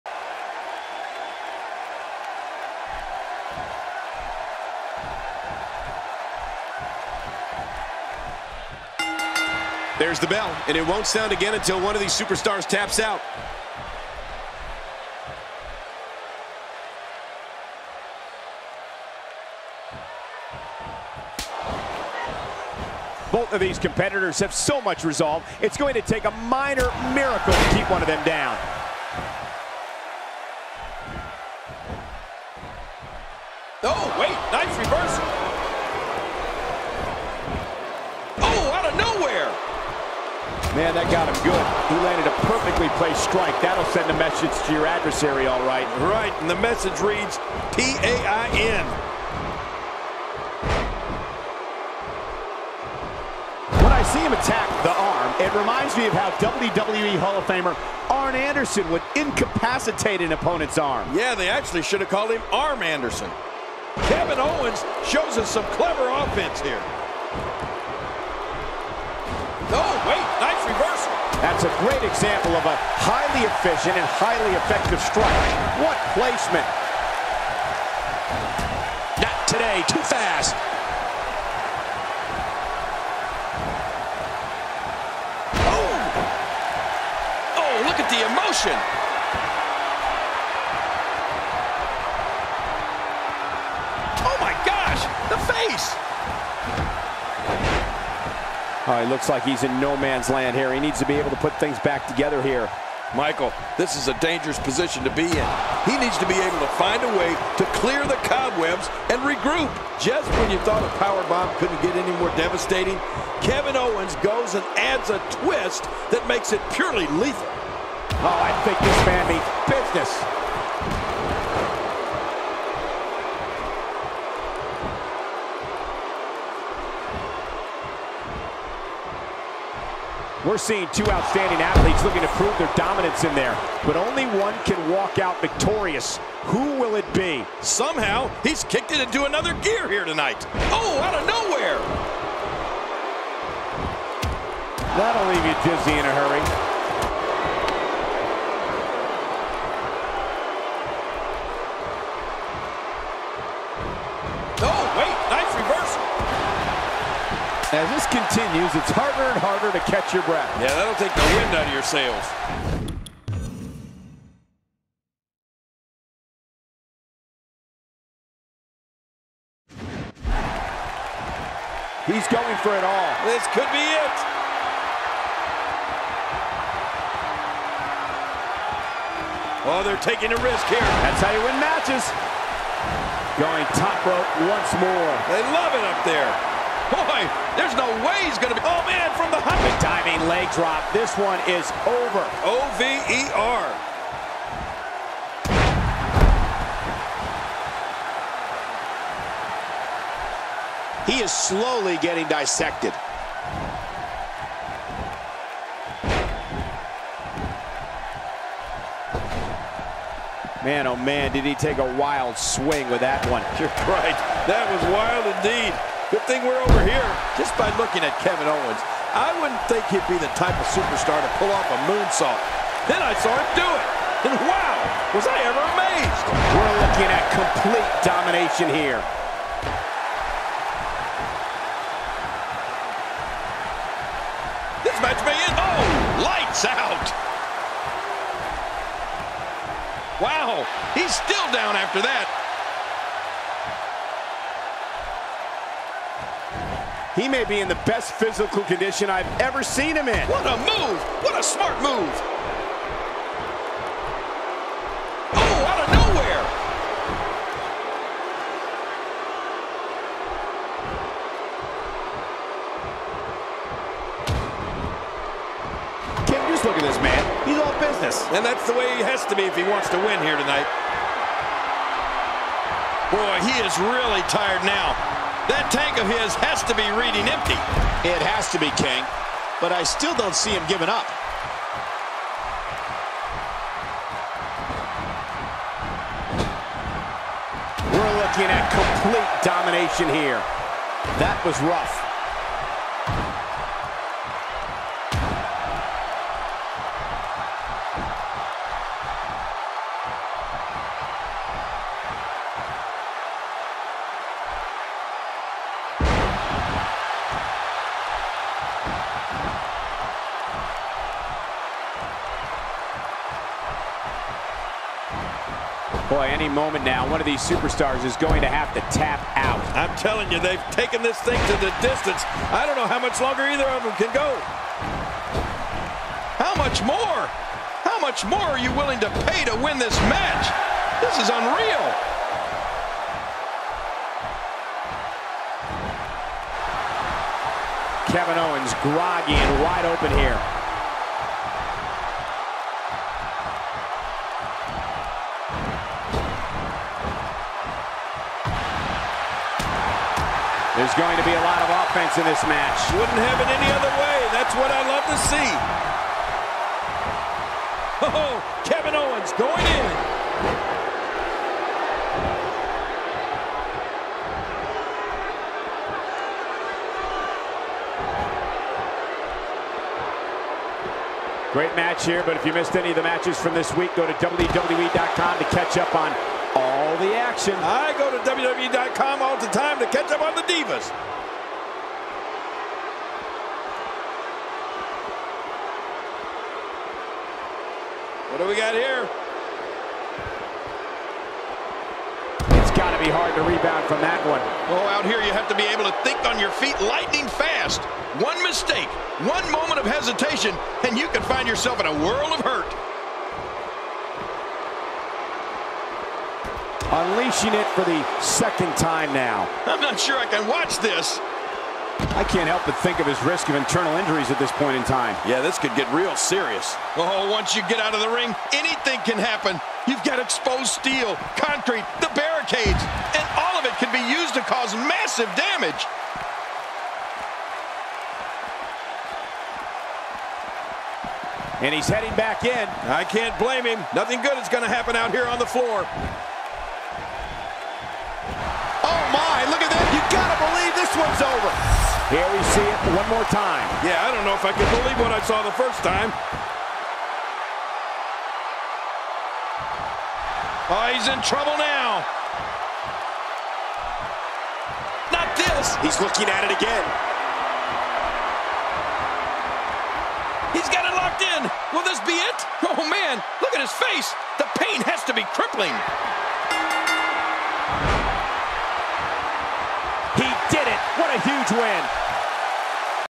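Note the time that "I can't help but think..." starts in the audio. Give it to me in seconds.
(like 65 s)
412 s.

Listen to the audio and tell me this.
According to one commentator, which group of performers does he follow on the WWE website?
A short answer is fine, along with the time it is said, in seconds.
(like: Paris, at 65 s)
the Divas, at 380 s.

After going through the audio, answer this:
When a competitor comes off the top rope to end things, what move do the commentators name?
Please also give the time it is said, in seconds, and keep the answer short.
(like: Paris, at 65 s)
leg drop, at 190 s.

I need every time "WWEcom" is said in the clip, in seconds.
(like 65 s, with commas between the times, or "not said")
374 s, 378 s.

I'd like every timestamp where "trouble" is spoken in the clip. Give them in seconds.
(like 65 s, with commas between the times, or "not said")
451 s.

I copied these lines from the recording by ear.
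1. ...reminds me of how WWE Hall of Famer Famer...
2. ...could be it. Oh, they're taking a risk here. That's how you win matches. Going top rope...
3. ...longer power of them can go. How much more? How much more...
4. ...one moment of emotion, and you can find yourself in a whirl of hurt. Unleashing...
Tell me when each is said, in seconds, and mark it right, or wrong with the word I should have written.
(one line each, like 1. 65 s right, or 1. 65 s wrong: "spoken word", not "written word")
1. 55 s wrong: "Arn", not "Famer"
2. 173 s right
3. 323 s wrong: "either", not "power"
4. 399 s wrong: "hesitation", not "emotion".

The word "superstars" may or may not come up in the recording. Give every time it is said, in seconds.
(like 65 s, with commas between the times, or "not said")
12 s, 220 s, 317 s.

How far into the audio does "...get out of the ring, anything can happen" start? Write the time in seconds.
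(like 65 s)
417 s.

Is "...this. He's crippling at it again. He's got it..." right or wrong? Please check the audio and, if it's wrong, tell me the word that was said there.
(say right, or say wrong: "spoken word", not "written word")
wrong: "looking", not "crippling".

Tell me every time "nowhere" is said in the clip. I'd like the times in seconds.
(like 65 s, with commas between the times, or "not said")
141 s, 255 s.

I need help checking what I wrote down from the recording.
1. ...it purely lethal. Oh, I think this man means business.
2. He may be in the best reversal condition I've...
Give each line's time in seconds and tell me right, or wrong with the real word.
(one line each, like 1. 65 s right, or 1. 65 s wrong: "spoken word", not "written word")
1. 116 s right
2. 247 s wrong: "physical", not "reversal".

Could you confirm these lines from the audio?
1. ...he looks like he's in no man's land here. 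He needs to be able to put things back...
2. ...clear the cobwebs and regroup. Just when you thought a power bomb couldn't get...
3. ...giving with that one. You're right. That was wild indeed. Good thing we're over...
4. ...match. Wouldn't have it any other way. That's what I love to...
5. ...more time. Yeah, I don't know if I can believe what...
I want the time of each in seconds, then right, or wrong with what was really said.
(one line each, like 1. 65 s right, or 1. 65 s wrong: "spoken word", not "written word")
1. 99 s right
2. 107 s right
3. 212 s wrong: "swing", not "giving"
4. 352 s right
5. 443 s right.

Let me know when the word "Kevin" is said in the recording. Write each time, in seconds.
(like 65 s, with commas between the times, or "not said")
64 s, 113 s, 218 s, 338 s, 358 s.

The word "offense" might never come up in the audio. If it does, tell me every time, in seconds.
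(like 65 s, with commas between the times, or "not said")
66 s, 351 s.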